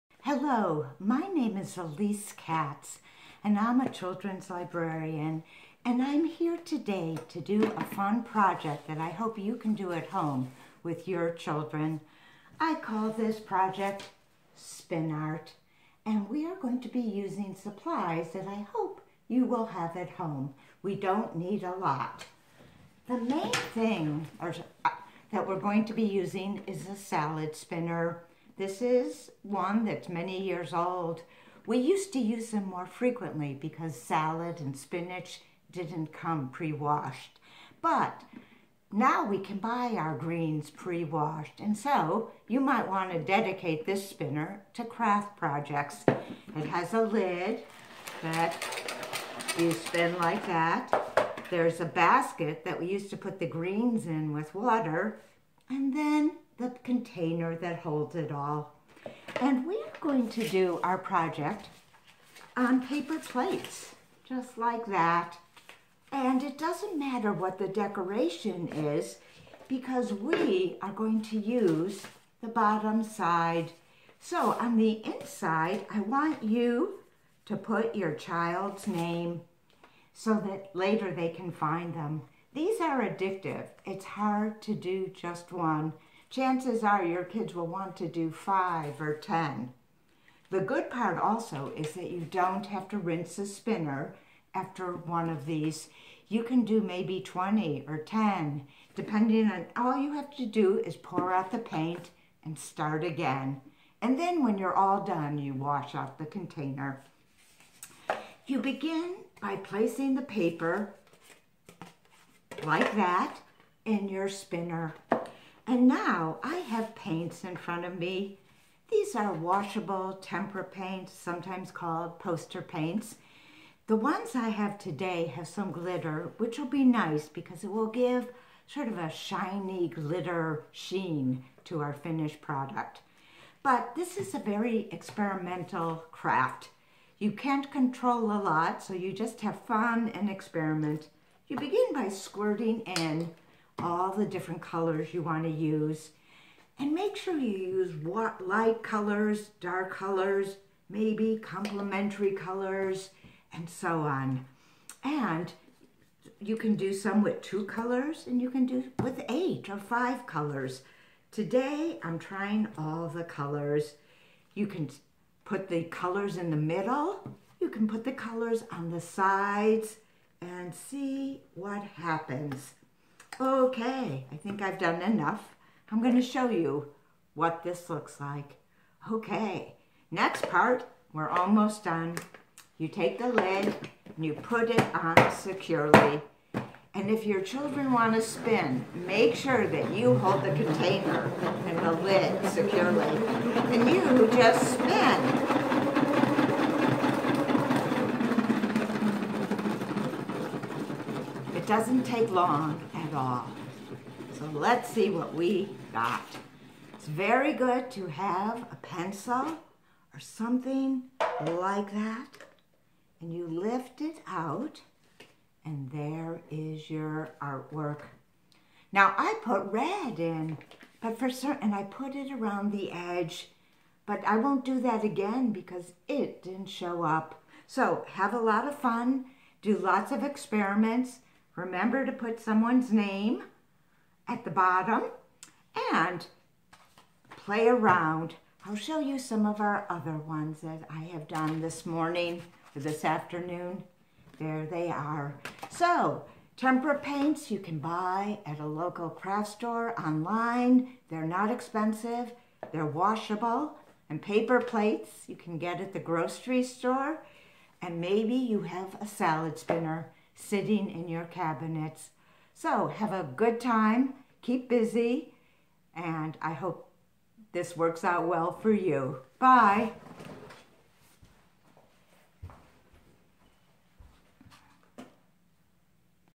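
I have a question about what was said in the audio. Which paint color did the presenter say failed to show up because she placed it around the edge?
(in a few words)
Red.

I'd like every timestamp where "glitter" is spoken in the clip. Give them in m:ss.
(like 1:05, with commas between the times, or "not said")
2:05, 2:09.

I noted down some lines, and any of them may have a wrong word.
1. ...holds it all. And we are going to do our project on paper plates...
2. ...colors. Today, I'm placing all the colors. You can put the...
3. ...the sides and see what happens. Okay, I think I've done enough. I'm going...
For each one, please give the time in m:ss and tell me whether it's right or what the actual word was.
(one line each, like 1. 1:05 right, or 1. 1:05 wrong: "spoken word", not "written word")
1. 0:57 right
2. 2:40 wrong: "trying", not "placing"
3. 2:48 right.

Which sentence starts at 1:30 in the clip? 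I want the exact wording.
The good part also is that you don't have to rinse the spinner after one of these.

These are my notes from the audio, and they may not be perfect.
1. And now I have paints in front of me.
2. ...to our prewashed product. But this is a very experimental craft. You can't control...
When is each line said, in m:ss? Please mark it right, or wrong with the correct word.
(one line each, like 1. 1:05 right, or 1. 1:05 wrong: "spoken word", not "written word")
1. 1:55 right
2. 2:11 wrong: "finished", not "prewashed".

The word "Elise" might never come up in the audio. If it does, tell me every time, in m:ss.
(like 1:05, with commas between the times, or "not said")
0:01.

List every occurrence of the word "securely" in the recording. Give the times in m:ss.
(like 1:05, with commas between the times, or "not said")
3:05, 3:12.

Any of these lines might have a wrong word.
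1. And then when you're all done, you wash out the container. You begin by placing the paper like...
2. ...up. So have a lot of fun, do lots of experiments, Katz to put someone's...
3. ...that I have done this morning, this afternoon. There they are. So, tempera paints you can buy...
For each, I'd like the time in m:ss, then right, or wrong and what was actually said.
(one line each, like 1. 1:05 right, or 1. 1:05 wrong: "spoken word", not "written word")
1. 1:44 right
2. 3:47 wrong: "Remember", not "Katz"
3. 4:00 right.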